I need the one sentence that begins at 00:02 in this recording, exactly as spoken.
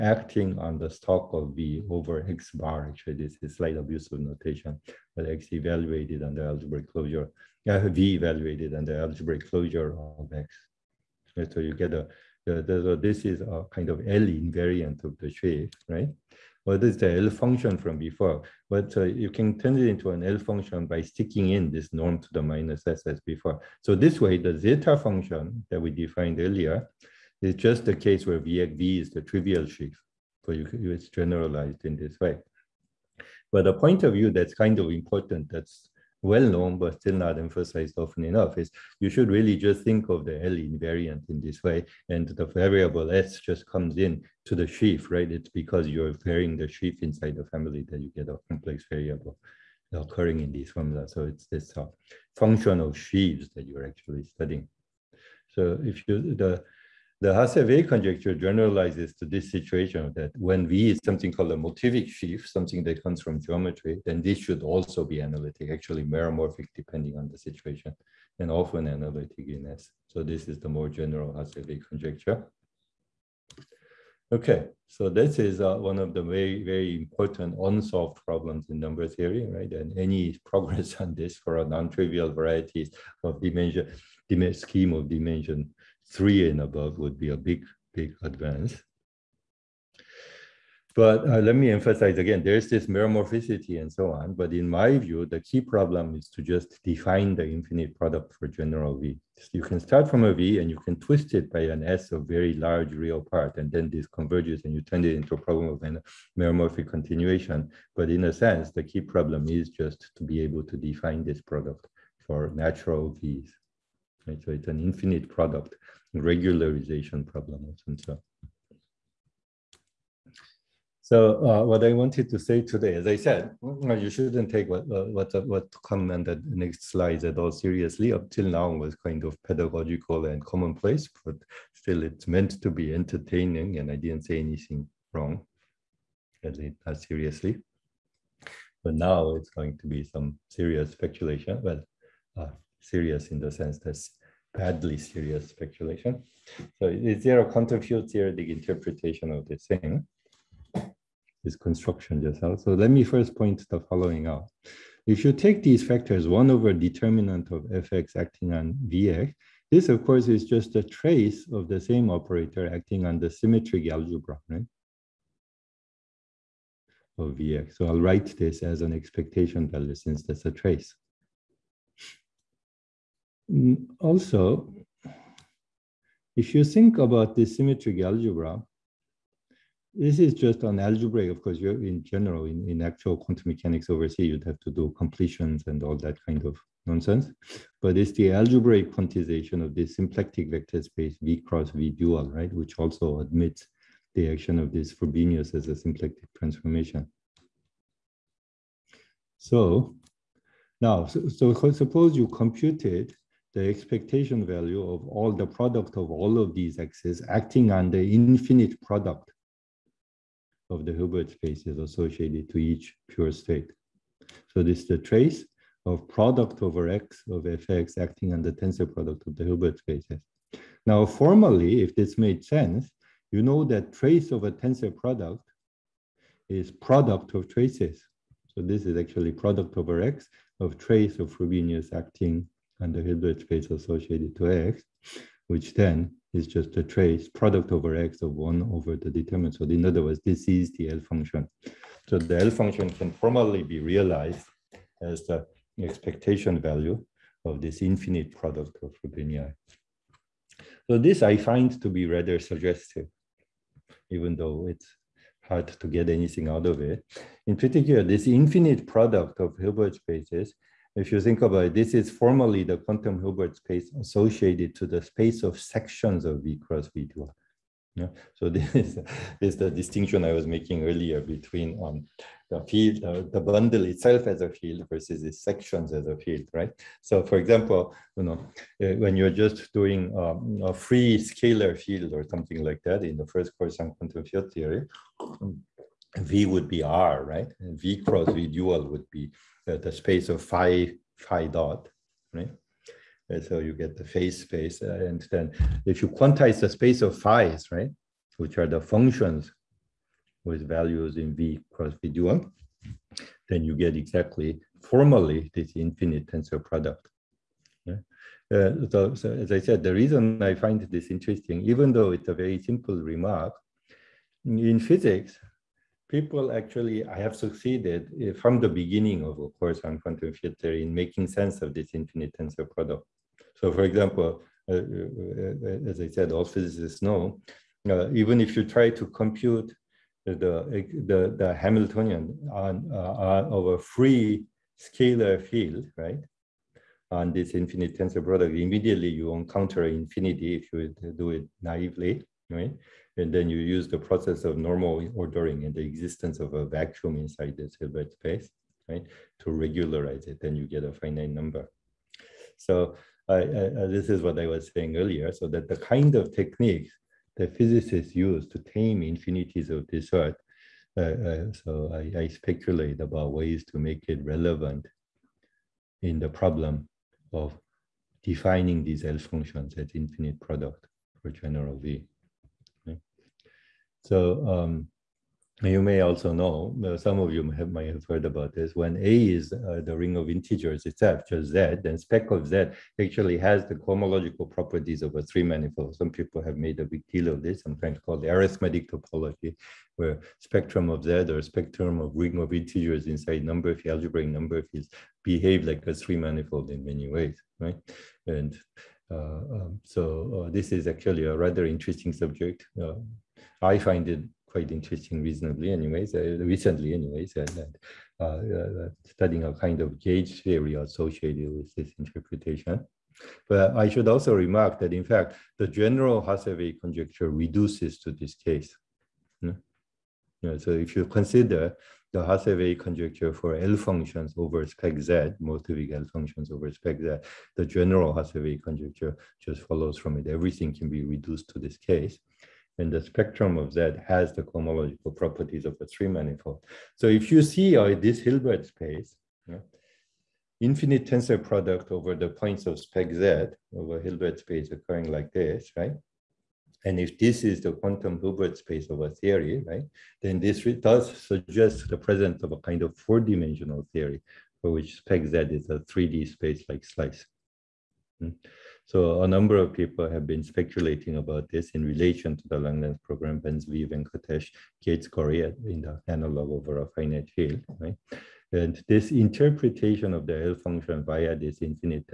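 Actually, this is slight abuse of notation, but X evaluated under algebraic closure, uh, V evaluated under algebraic closure of X.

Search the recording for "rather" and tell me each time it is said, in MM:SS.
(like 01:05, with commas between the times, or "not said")
04:12, 06:41.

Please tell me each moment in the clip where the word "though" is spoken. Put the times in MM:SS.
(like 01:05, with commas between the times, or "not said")
04:14, 05:11.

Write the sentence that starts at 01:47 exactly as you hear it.
But in a sense, the key problem is just to be able to define this product for natural Vs.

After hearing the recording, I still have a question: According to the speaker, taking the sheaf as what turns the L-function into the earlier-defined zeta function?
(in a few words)
the trivial sheaf.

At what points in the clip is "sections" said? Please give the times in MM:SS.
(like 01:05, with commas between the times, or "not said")
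04:25, 04:35.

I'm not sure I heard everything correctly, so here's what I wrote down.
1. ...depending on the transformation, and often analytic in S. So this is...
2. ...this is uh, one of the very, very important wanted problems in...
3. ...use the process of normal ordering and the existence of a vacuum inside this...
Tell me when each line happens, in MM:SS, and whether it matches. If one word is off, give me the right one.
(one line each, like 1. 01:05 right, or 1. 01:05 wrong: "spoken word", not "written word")
1. 01:06 wrong: "situation", not "transformation"
2. 01:15 wrong: "unsolved", not "wanted"
3. 05:43 right.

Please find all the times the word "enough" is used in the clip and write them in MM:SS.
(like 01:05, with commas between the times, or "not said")
00:38.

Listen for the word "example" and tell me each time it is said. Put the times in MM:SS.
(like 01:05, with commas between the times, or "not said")
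04:37, 05:23.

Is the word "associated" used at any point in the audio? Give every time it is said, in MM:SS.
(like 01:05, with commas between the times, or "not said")
03:31, 03:53, 04:23, 06:50.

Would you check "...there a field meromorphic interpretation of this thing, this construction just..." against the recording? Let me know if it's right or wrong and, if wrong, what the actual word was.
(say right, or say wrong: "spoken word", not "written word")
wrong: "theoretic", not "meromorphic".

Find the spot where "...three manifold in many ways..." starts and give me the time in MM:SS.
06:35.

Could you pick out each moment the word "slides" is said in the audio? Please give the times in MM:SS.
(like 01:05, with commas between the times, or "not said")
02:06.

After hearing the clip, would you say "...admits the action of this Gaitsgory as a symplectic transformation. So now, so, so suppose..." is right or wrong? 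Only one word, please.
wrong.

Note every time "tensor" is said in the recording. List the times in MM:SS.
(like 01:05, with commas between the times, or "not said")
03:38, 03:44, 05:06, 05:22, 05:37, 07:21.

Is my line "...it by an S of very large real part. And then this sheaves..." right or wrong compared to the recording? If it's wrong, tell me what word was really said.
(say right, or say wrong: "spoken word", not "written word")
wrong: "converges", not "sheaves".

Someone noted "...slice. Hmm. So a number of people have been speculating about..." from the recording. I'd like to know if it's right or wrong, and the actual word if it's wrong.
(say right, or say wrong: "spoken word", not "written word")
right.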